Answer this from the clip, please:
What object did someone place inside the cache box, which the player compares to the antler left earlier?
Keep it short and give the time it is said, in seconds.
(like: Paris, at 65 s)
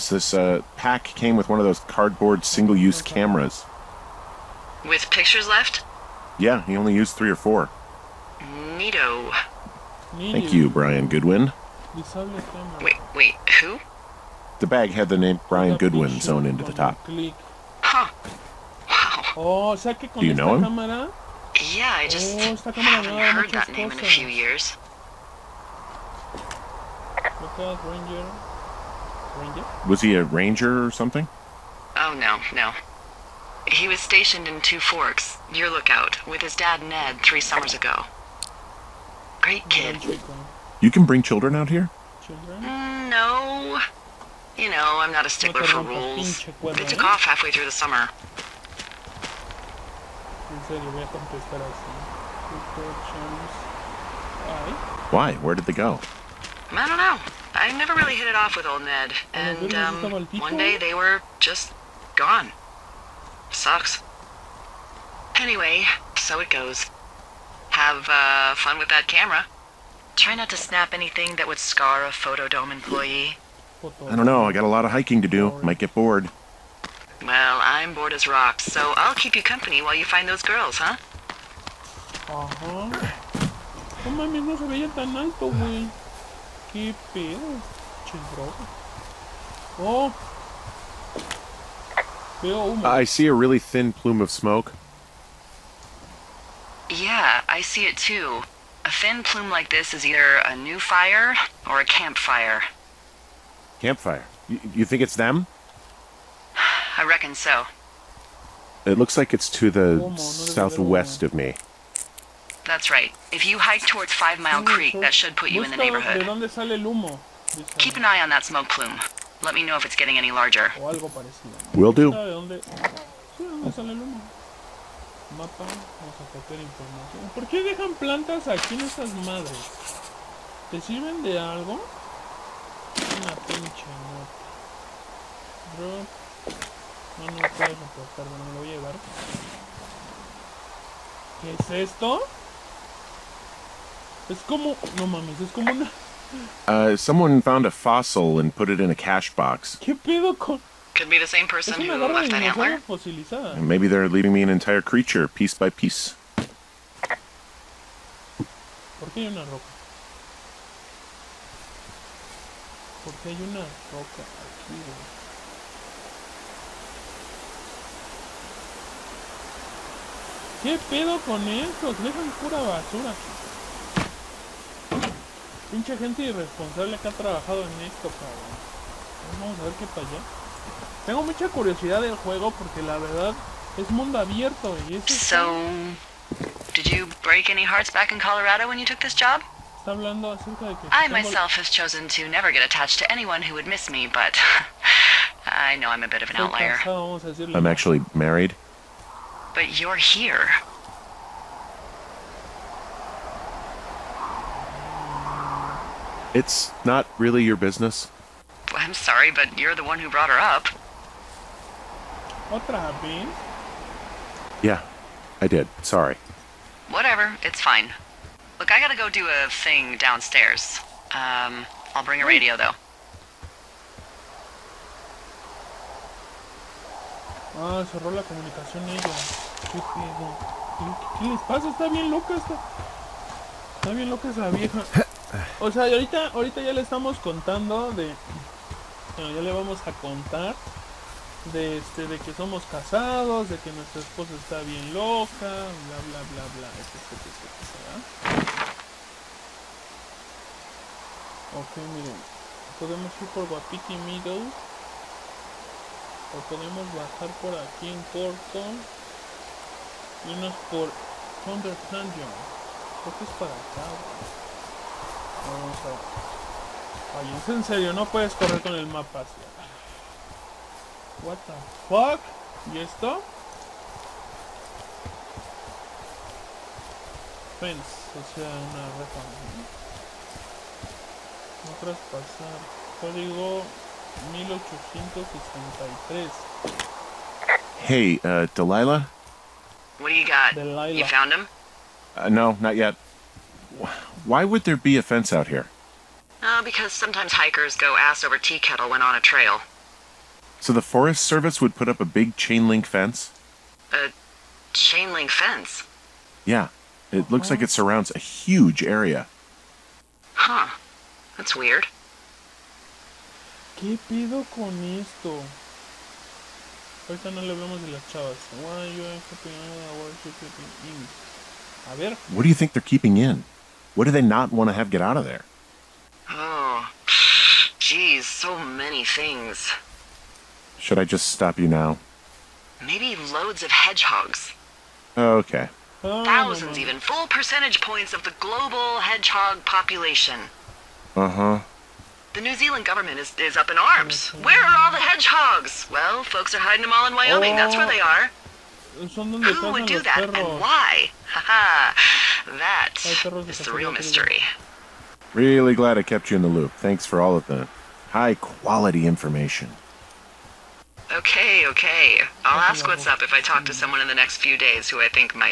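A fossil, at 147 s.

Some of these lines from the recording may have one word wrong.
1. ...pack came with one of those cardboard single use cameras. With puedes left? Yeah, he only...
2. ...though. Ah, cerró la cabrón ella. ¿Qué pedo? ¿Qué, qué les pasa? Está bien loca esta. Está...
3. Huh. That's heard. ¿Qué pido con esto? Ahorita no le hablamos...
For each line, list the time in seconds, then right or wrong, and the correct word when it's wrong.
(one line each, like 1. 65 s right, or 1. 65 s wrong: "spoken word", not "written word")
1. 0 s wrong: "pictures", not "puedes"
2. 222 s wrong: "comunicación", not "cabrón"
3. 310 s wrong: "weird", not "heard".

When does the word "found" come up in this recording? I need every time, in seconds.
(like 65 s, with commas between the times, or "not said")
147 s, 291 s.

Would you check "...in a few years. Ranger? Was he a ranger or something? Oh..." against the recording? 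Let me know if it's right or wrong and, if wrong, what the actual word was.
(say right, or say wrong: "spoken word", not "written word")
right.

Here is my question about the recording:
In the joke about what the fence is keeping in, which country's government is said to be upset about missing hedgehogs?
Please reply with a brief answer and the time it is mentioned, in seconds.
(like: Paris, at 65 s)
New Zealand, at 342 s.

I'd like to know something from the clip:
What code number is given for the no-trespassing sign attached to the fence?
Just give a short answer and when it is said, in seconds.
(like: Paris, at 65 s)
1863, at 284 s.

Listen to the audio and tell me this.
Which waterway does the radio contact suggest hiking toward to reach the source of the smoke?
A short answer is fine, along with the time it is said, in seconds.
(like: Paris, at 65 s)
Five Mile Creek, at 114 s.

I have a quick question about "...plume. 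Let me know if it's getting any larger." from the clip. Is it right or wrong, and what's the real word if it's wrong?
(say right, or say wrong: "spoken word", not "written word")
right.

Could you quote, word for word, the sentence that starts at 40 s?
You can bring children out here?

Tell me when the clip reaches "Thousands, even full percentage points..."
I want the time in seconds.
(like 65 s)
336 s.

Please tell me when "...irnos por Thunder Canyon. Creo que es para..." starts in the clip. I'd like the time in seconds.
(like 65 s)
260 s.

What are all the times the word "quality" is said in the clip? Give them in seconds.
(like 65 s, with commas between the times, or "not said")
358 s.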